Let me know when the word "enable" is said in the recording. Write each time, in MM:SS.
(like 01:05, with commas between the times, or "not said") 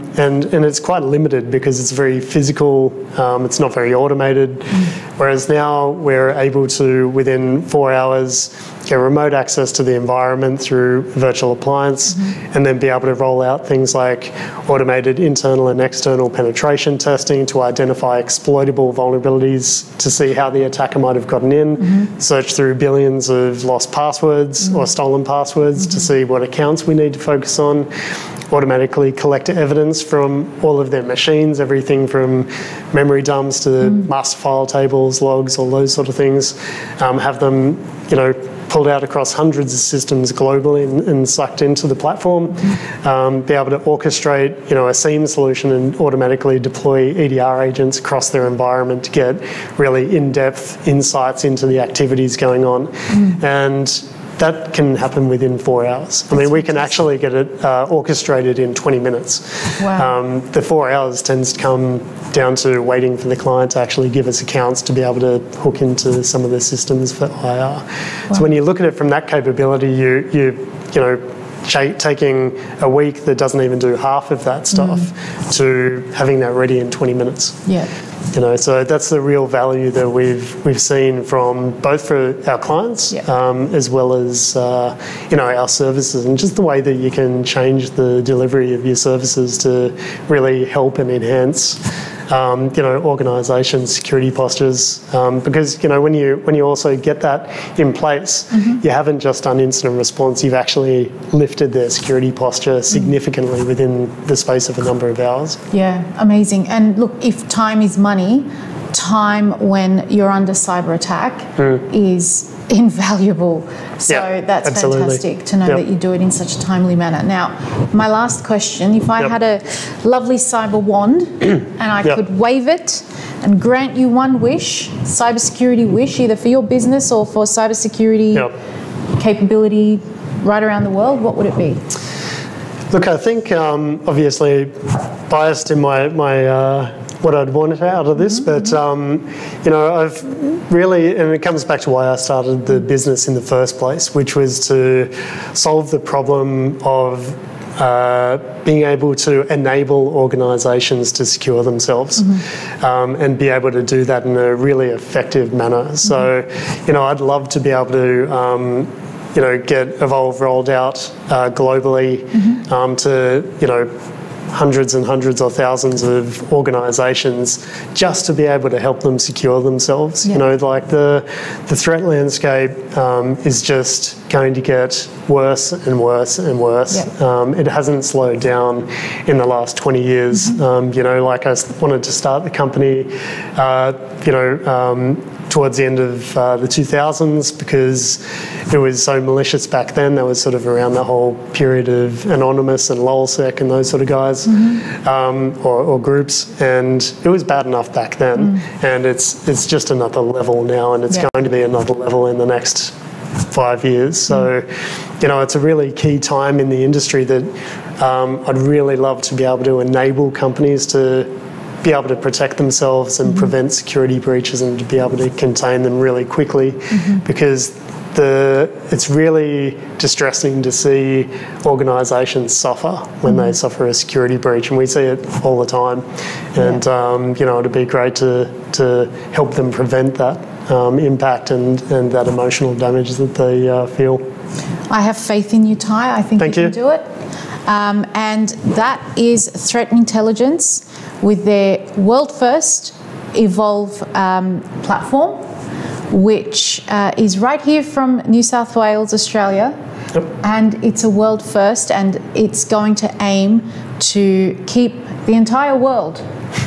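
02:29, 03:29.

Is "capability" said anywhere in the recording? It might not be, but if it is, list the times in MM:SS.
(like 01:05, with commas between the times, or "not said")
01:09, 02:09.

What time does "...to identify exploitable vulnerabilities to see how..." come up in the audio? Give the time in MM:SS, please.
00:17.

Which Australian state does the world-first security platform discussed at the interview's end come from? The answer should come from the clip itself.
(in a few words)
New South Wales.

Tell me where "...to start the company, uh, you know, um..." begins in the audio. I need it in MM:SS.
03:02.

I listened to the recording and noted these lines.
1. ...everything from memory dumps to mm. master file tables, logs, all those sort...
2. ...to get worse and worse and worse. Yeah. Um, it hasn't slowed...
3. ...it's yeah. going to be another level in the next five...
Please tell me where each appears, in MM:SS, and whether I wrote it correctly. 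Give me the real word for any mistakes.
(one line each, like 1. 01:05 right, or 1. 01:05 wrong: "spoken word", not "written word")
1. 00:31 right
2. 02:54 right
3. 03:21 right.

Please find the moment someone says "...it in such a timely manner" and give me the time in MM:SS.
01:56.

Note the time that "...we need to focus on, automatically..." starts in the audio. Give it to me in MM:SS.
00:26.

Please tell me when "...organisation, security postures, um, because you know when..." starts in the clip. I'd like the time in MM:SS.
01:33.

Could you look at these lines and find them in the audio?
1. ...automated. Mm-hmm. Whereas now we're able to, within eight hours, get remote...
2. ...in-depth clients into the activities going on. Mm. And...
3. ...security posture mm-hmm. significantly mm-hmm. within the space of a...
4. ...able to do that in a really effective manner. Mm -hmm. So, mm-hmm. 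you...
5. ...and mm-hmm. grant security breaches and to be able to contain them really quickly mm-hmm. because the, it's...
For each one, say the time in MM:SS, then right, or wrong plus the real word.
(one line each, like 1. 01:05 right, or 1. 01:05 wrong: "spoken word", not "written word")
1. 00:04 wrong: "four", not "eight"
2. 00:50 wrong: "insights", not "clients"
3. 01:41 right
4. 02:33 right
5. 03:33 wrong: "prevent", not "grant".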